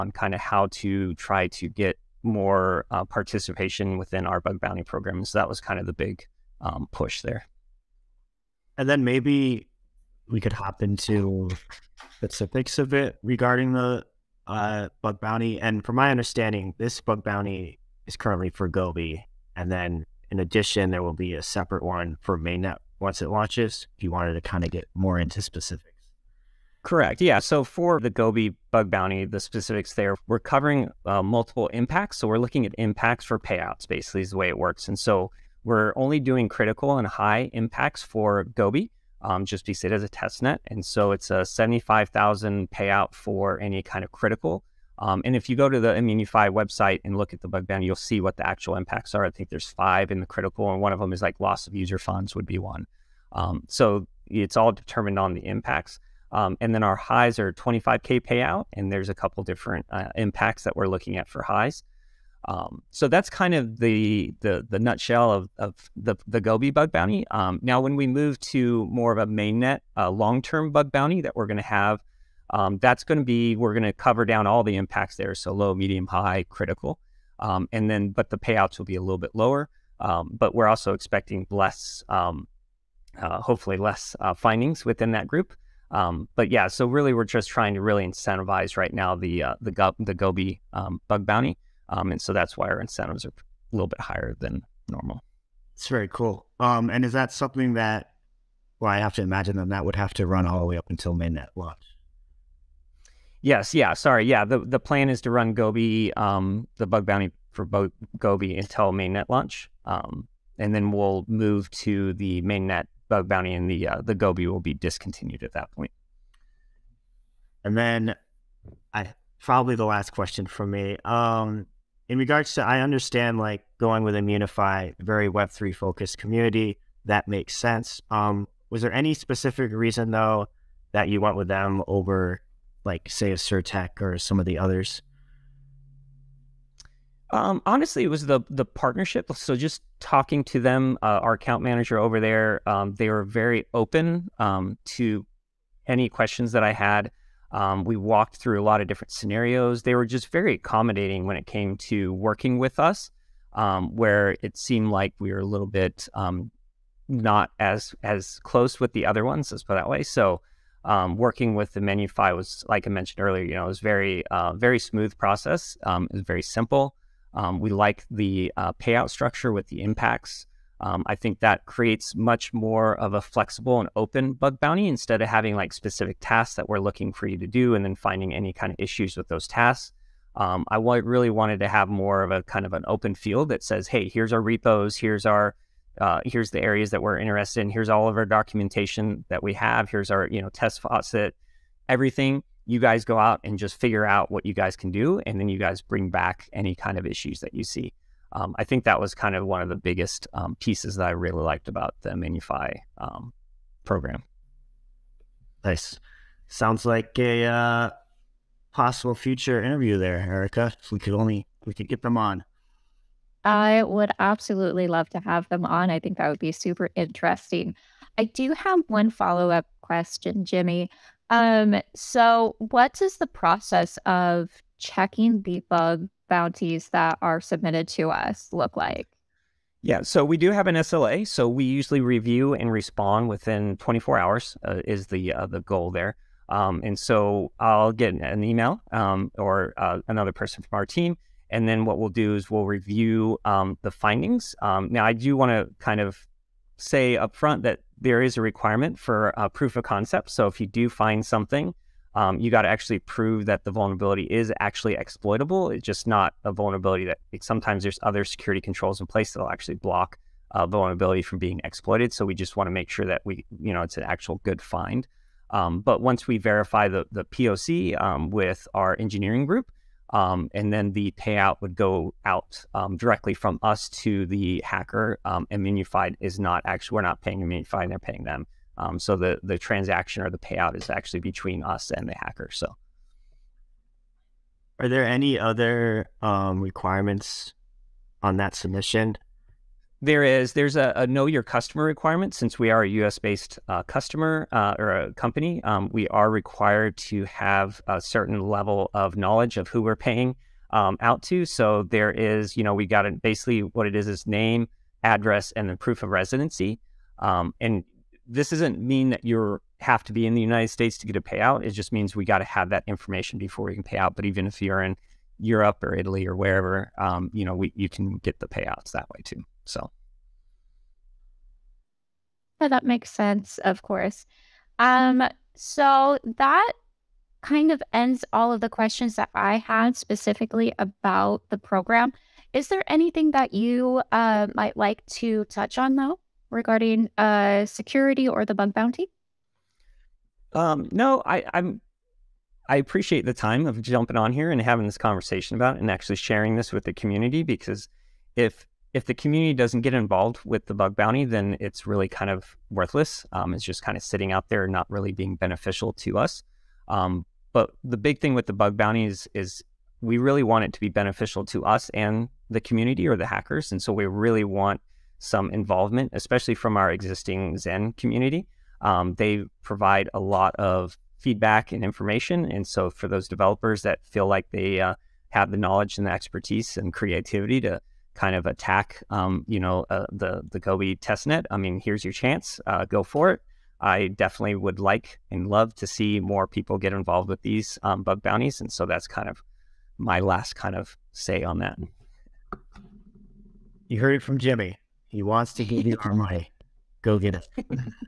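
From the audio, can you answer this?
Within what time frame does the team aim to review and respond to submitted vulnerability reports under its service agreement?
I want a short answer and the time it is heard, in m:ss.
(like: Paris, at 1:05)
24 hours, at 3:53.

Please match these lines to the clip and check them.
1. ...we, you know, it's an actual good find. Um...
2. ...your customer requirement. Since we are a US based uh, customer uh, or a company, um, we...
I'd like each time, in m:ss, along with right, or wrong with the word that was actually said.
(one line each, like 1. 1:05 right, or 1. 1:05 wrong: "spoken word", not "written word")
1. 4:23 right
2. 4:51 right.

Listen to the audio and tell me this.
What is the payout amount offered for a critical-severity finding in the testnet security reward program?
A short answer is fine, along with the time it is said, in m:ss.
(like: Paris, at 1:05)
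$75,000, at 0:41.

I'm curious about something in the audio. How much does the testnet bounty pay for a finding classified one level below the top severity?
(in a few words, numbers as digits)
$25,000.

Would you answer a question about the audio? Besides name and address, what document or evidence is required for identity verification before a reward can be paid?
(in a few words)
proof of residency.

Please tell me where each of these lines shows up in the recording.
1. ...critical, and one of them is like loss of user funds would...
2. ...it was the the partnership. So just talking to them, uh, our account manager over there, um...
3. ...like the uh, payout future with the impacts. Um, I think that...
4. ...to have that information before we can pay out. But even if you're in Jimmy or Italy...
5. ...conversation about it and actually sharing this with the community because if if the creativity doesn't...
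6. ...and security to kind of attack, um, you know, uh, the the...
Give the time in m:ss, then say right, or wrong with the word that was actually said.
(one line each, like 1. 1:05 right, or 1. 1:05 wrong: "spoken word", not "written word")
1. 0:50 right
2. 2:18 right
3. 2:47 wrong: "structure", not "future"
4. 5:12 wrong: "Europe", not "Jimmy"
5. 5:44 wrong: "community", not "creativity"
6. 6:16 wrong: "creativity", not "security".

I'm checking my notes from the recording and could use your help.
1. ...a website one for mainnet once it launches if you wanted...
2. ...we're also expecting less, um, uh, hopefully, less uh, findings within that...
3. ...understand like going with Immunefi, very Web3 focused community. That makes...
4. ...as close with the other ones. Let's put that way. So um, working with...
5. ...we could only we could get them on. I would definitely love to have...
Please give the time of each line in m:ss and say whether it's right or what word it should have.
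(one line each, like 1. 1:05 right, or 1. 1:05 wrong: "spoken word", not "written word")
1. 0:21 wrong: "separate", not "website"
2. 1:20 right
3. 2:02 right
4. 2:38 right
5. 3:30 wrong: "absolutely", not "definitely".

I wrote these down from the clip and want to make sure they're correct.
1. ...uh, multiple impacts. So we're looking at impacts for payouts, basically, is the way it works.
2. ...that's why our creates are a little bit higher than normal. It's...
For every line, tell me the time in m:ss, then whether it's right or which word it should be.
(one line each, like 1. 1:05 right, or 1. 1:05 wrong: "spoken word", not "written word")
1. 0:31 right
2. 1:32 wrong: "incentives", not "creates".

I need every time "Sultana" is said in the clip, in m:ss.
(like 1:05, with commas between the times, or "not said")
not said.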